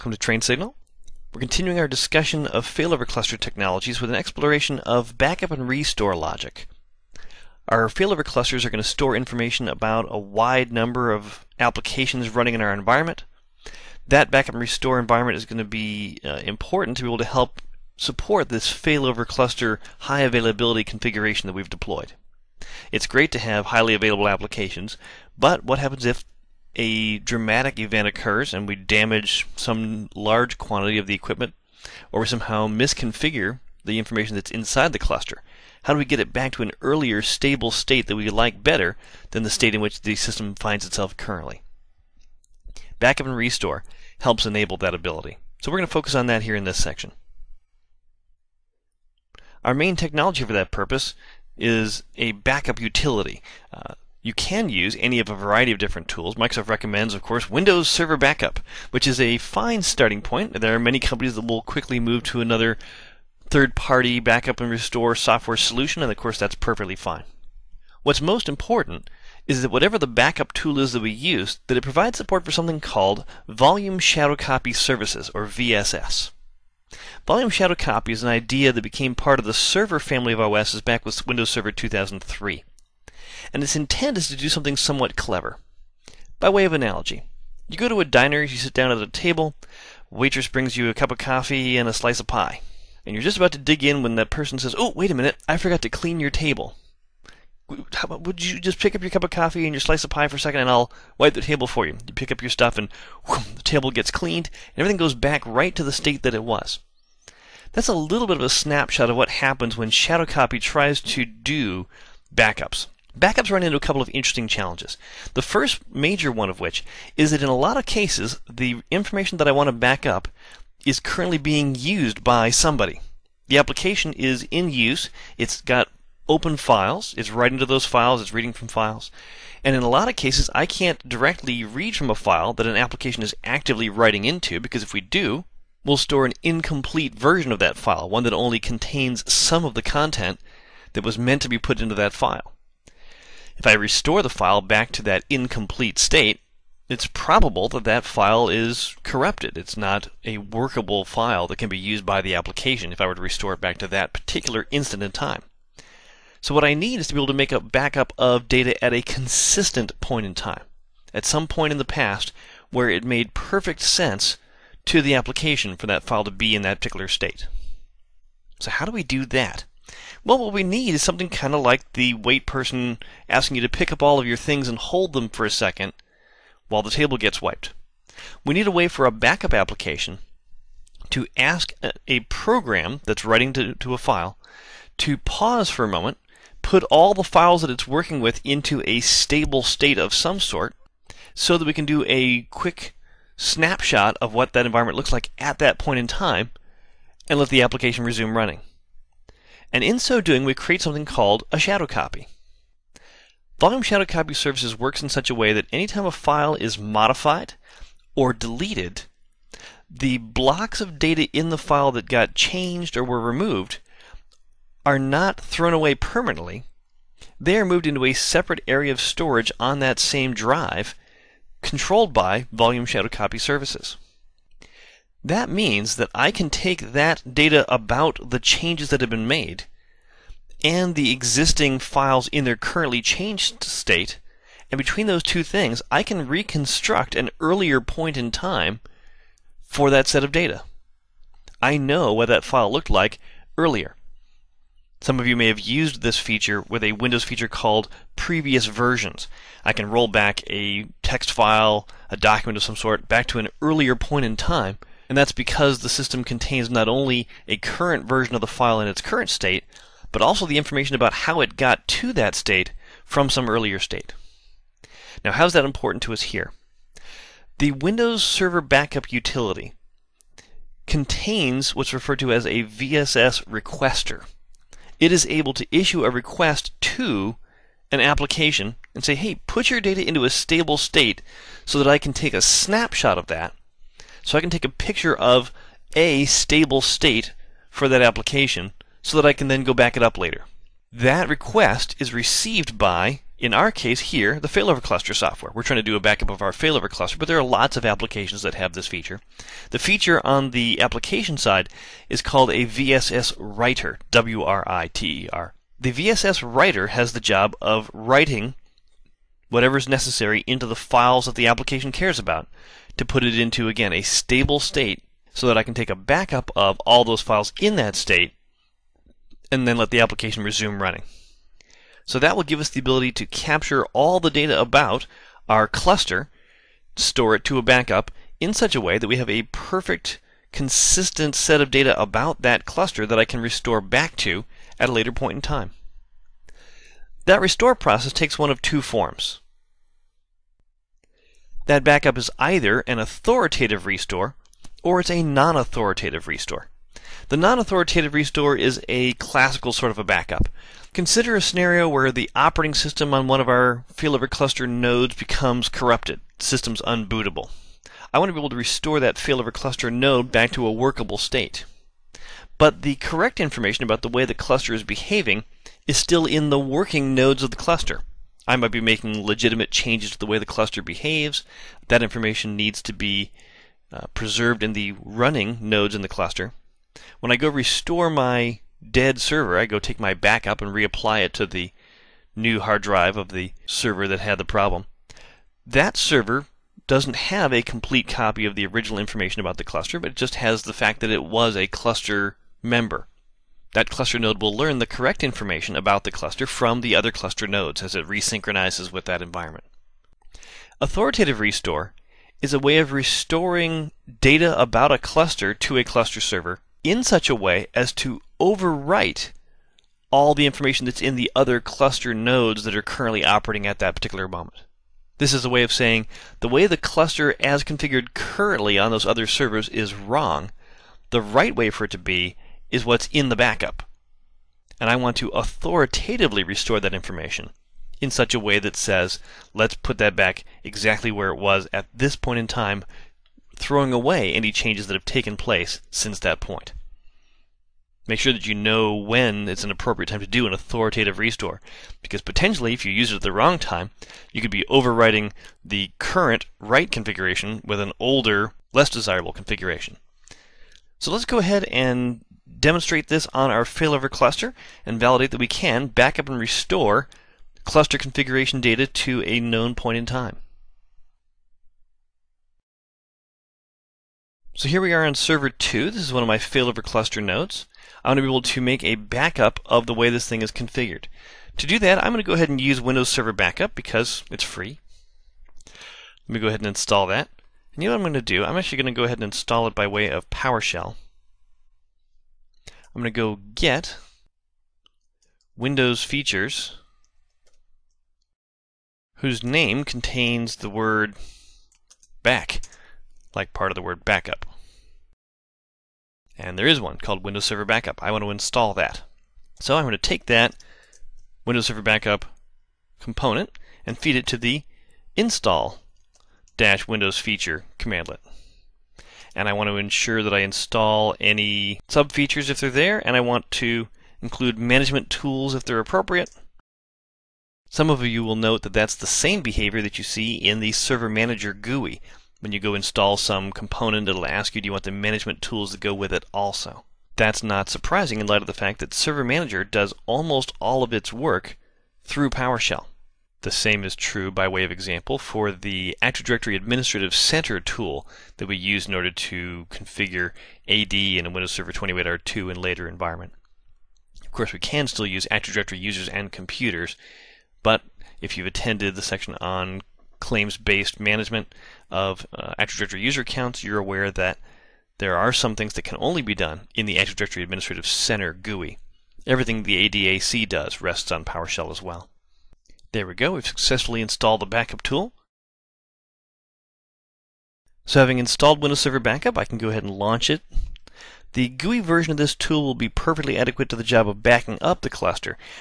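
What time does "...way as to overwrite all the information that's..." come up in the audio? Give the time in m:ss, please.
6:47.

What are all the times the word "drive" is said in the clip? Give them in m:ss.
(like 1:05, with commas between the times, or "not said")
3:40, 6:22.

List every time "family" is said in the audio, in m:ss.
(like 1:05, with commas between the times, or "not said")
1:19.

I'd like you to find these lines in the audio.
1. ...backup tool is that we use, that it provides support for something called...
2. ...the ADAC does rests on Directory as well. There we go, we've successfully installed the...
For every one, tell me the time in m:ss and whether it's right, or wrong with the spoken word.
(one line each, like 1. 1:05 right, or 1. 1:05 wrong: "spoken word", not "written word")
1. 1:10 right
2. 9:19 wrong: "PowerShell", not "Directory".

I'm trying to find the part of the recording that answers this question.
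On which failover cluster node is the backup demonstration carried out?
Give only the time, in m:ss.
7:45.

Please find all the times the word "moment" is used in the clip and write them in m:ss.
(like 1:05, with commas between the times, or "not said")
3:05, 6:54.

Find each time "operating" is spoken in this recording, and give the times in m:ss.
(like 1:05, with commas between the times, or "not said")
5:52, 6:53.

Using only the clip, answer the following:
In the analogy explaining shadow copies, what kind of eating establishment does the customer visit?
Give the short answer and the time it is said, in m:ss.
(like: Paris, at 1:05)
A diner, at 1:28.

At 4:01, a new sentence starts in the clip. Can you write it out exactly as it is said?
I know what that file looked like earlier.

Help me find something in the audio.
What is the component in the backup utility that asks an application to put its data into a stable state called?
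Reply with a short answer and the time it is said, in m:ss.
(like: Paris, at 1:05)
VSS requester, at 4:32.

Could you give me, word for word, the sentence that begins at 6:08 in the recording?
I might be making legitimate changes to the way the cluster behaves.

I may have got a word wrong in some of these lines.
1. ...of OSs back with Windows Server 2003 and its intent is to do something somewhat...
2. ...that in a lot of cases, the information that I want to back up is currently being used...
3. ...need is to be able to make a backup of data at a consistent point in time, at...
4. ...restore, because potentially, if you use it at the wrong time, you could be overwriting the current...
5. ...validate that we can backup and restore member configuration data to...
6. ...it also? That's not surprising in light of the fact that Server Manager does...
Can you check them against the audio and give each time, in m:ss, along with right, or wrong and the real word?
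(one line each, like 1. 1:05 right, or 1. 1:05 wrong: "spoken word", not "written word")
1. 1:20 right
2. 1:57 right
3. 2:36 right
4. 7:21 right
5. 7:34 wrong: "cluster", not "member"
6. 8:46 right.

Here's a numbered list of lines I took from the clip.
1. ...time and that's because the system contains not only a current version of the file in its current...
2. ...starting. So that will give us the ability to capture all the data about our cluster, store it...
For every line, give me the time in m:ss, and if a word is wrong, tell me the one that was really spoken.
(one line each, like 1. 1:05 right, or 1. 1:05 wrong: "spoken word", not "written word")
1. 4:14 right
2. 5:20 wrong: "running", not "starting".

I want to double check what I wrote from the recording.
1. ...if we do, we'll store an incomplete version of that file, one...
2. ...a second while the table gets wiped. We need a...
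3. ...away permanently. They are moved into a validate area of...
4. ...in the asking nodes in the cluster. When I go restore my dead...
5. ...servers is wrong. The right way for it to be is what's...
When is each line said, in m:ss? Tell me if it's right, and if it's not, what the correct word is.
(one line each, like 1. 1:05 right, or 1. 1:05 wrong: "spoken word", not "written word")
1. 2:14 right
2. 2:55 right
3. 3:35 wrong: "separate", not "validate"
4. 6:14 wrong: "running", not "asking"
5. 6:59 right.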